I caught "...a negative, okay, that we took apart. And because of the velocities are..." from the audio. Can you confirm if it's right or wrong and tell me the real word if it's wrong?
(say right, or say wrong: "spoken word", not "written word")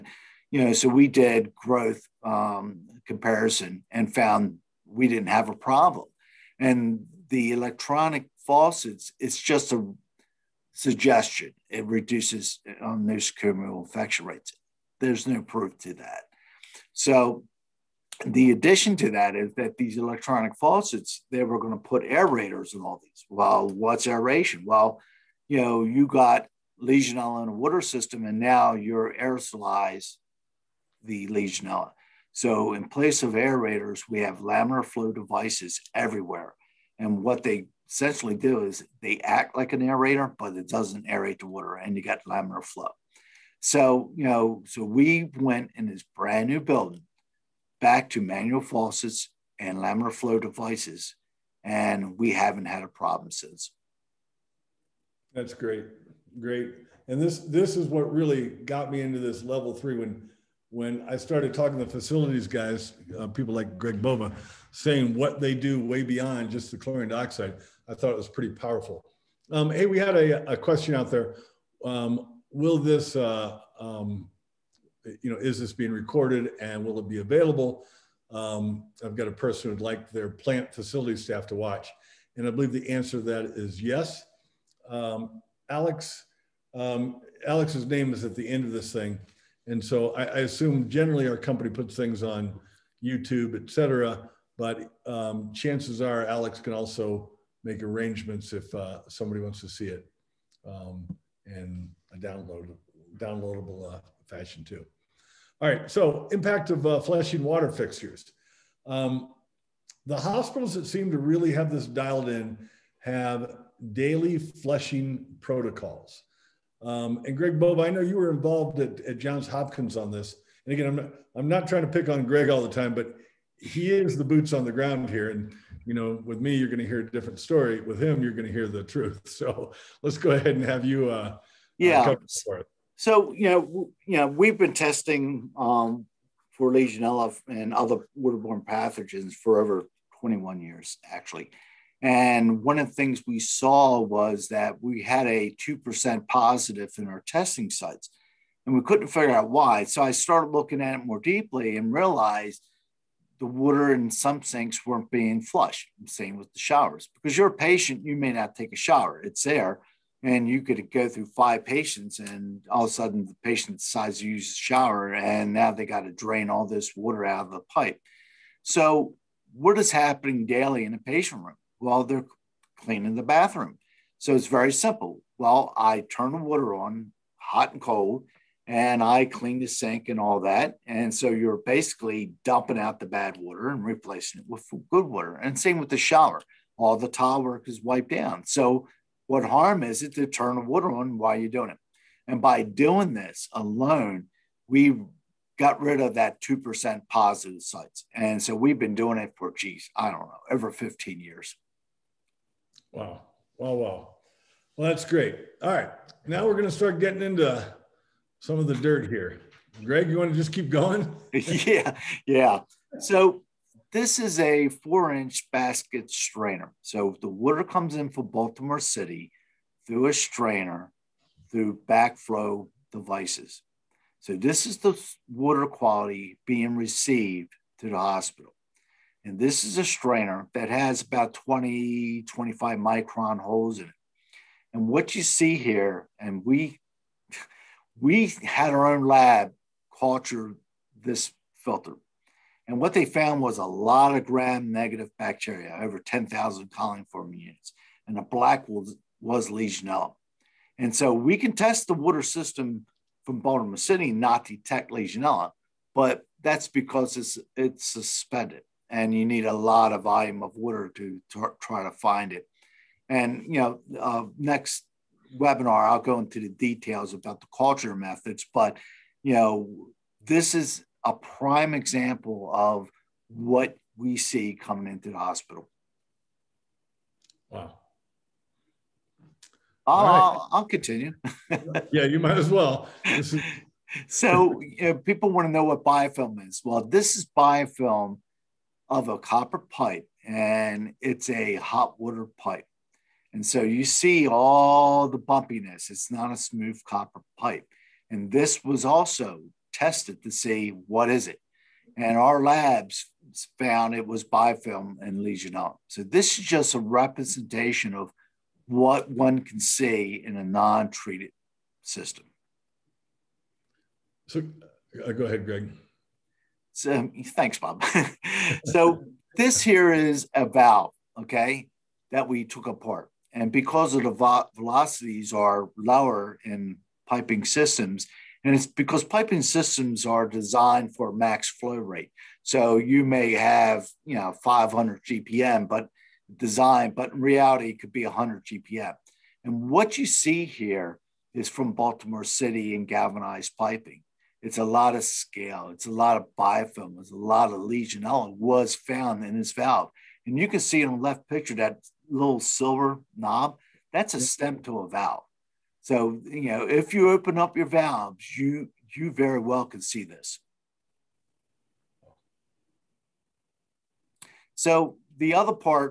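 wrong: "valve", not "negative".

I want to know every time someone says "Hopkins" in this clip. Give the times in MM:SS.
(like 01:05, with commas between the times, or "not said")
01:59.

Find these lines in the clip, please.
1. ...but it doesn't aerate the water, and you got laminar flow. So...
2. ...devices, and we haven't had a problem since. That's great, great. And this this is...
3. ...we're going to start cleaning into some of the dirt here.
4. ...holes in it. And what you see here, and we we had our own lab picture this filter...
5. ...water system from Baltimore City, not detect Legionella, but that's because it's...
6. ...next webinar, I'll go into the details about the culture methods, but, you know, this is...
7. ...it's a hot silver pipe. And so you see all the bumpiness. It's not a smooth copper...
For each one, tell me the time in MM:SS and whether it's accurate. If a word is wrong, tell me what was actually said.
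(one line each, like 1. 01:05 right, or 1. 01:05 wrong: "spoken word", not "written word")
1. 00:40 right
2. 00:50 right
3. 03:26 wrong: "getting", not "cleaning"
4. 03:53 wrong: "culture", not "picture"
5. 04:11 right
6. 04:24 right
7. 04:51 wrong: "water", not "silver".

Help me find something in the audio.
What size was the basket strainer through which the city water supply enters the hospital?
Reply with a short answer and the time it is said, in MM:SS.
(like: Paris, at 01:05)
4 inch, at 03:34.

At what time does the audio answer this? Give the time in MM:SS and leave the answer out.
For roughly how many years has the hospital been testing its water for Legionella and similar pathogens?
02:19.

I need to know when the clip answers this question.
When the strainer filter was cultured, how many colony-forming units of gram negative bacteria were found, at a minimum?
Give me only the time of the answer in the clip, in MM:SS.
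04:05.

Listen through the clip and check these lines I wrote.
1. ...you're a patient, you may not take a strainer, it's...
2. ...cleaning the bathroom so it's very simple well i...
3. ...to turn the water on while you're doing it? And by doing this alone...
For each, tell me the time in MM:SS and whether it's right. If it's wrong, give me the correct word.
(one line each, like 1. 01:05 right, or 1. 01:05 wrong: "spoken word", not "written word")
1. 02:37 wrong: "shower", not "strainer"
2. 02:52 right
3. 03:10 right.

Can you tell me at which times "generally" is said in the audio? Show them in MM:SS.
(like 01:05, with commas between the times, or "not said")
01:30.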